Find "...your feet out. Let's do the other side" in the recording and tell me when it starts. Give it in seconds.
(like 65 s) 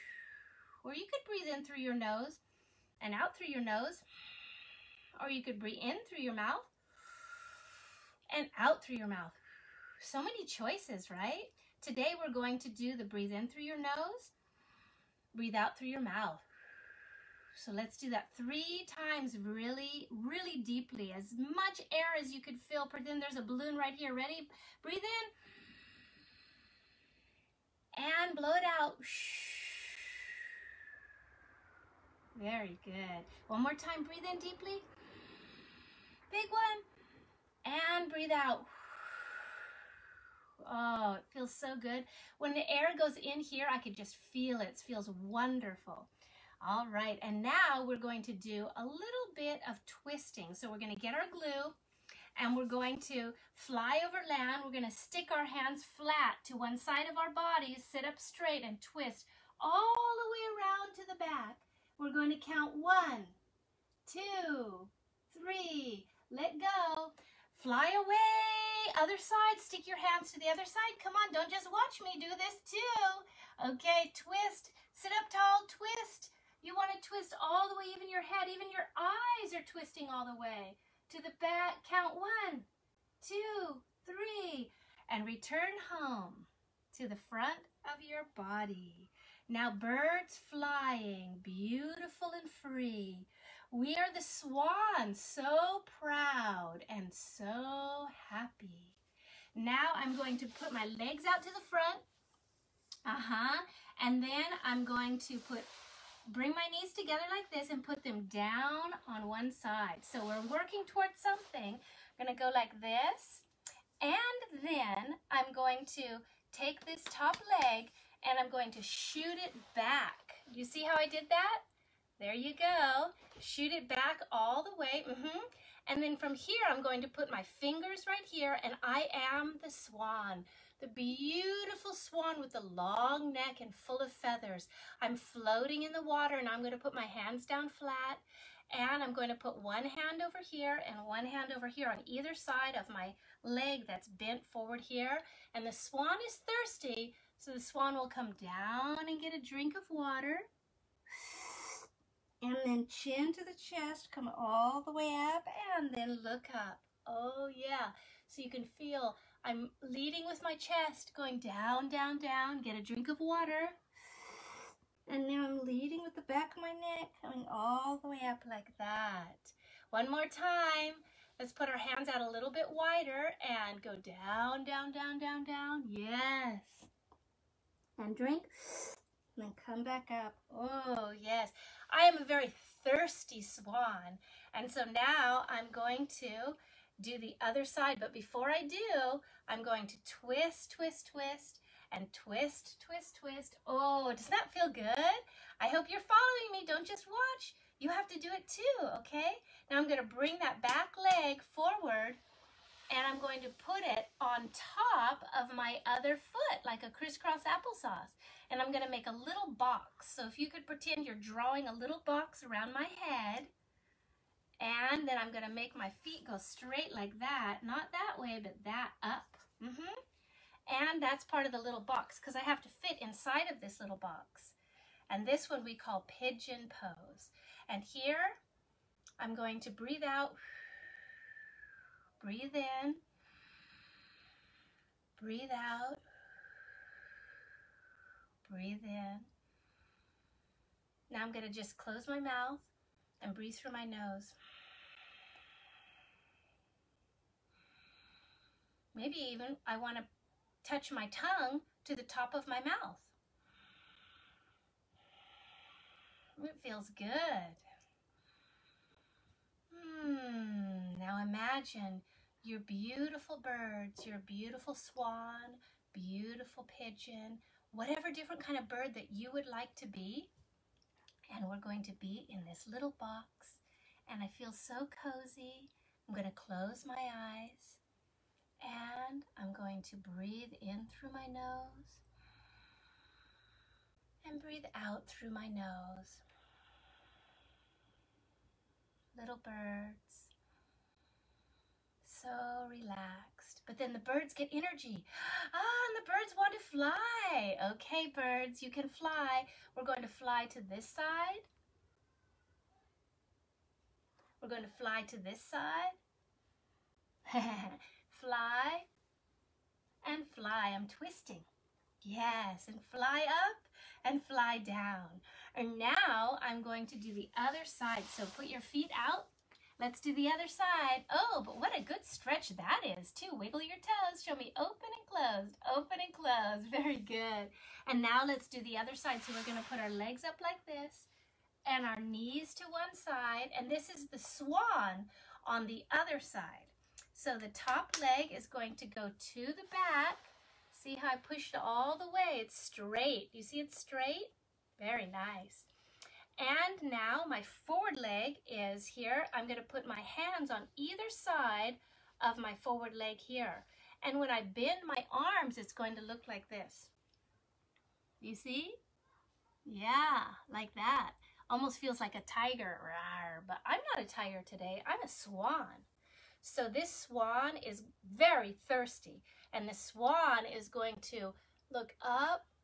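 318 s.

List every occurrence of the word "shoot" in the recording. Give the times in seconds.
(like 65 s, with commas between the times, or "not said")
118 s, 123 s.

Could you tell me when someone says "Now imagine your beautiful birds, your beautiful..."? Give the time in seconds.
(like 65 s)
260 s.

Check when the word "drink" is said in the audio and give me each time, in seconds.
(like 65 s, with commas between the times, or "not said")
149 s, 162 s, 178 s.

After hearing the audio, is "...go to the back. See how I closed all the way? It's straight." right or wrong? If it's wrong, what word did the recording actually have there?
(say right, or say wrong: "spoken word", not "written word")
wrong: "pushed", not "closed".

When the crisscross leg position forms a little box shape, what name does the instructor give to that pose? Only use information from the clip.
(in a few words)
Pigeon pose.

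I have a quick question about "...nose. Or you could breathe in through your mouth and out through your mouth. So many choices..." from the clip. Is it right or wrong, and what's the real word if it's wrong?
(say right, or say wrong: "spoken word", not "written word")
right.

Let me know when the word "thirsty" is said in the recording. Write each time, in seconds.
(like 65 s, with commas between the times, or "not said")
146 s, 182 s, 368 s.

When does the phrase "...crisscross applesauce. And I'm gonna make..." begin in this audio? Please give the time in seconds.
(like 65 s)
206 s.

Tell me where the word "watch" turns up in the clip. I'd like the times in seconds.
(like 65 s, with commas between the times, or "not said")
71 s, 197 s.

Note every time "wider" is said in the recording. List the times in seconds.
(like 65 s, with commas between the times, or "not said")
172 s.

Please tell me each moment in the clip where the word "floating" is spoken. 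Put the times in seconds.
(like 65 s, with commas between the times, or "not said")
135 s.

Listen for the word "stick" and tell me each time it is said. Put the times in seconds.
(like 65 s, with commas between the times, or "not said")
54 s, 69 s.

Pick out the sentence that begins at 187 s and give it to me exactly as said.
But before I do, I'm going to twist, twist, twist, and twist, twist, twist.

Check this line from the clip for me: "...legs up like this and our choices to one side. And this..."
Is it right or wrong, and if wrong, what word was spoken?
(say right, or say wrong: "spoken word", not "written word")
wrong: "knees", not "choices".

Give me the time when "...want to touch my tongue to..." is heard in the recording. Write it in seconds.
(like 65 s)
249 s.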